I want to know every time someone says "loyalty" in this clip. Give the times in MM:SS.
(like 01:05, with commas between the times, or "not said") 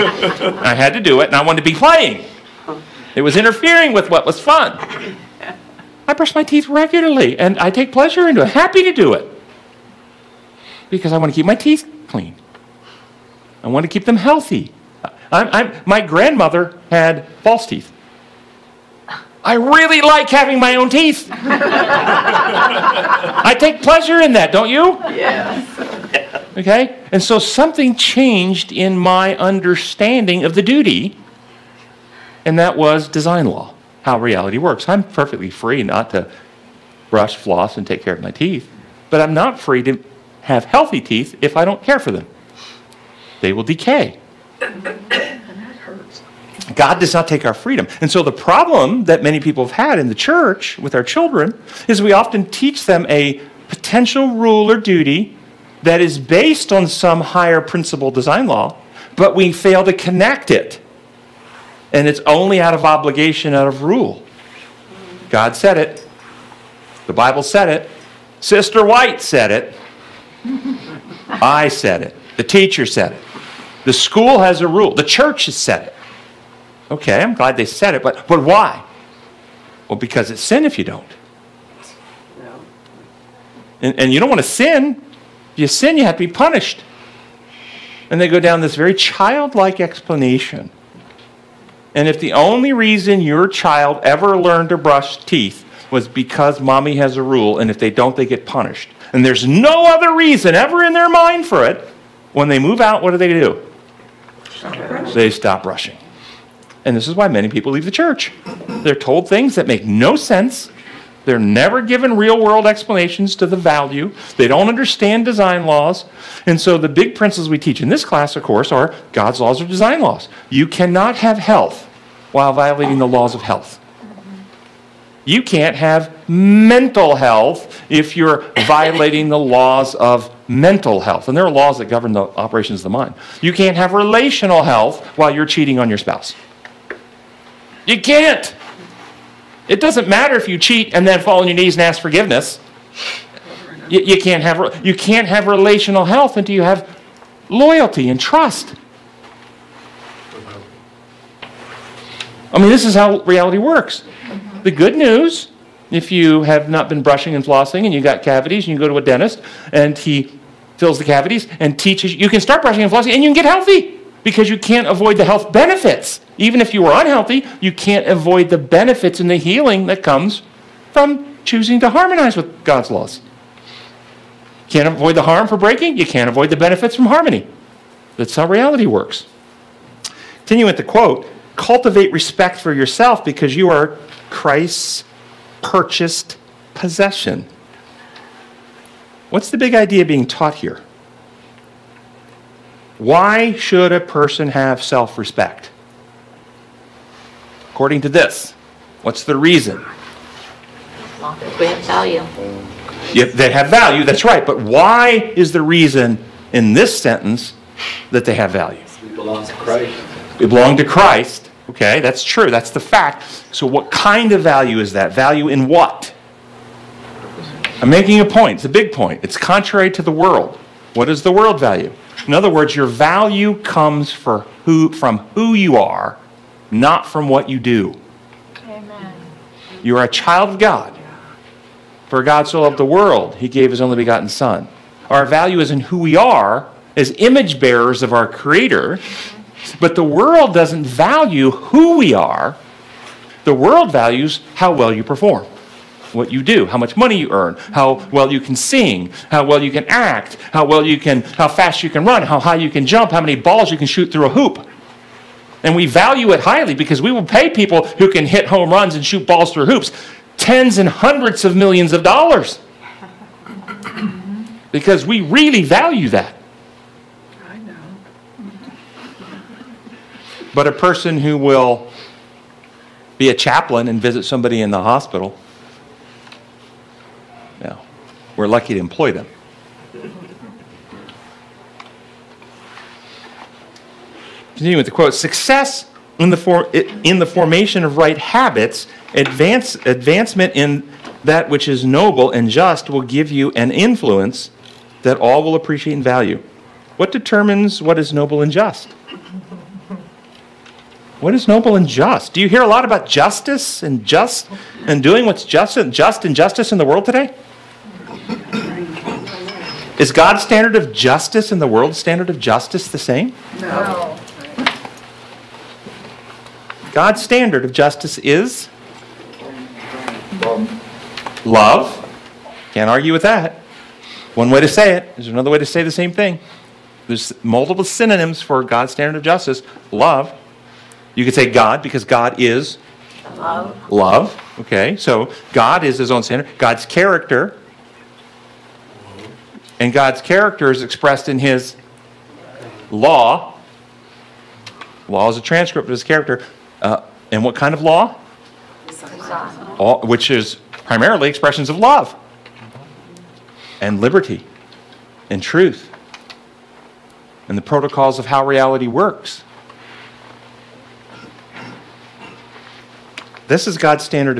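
02:27.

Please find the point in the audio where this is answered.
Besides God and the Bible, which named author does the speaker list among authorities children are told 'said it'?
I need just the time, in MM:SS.
01:08.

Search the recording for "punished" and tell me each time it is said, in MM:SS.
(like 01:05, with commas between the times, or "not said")
01:26, 01:38.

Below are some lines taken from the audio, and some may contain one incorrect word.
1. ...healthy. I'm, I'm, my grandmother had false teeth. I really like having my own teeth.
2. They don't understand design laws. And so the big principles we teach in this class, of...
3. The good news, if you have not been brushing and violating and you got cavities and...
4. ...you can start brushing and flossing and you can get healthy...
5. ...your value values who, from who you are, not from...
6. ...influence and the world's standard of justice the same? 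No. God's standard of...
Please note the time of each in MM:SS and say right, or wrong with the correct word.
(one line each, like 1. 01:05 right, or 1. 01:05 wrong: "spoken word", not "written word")
1. 00:14 right
2. 01:54 right
3. 02:34 wrong: "flossing", not "violating"
4. 02:42 right
5. 03:42 wrong: "comes", not "values"
6. 05:10 wrong: "justice", not "influence".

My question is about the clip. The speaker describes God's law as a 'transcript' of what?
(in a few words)
His character.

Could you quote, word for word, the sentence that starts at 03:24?
But why is the reason in this sentence that they have value?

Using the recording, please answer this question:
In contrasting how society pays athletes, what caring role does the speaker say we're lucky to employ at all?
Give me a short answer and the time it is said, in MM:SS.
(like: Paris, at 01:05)
Chaplain, at 04:33.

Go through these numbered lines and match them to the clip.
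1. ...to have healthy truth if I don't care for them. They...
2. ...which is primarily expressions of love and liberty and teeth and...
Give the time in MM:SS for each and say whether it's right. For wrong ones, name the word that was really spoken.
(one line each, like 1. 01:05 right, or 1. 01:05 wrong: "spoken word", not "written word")
1. 00:39 wrong: "teeth", not "truth"
2. 05:50 wrong: "truth", not "teeth".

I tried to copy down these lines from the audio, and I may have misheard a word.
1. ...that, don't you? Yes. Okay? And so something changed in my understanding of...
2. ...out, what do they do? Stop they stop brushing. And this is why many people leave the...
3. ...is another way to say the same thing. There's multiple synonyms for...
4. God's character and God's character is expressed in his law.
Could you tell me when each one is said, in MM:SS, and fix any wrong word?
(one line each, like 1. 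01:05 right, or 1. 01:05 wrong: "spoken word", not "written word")
1. 00:24 right
2. 01:42 right
3. 05:25 right
4. 05:36 right.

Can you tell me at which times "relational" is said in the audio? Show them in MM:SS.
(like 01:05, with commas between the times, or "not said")
02:13, 02:25.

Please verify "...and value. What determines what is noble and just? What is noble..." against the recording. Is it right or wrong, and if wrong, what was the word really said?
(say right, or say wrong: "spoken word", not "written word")
right.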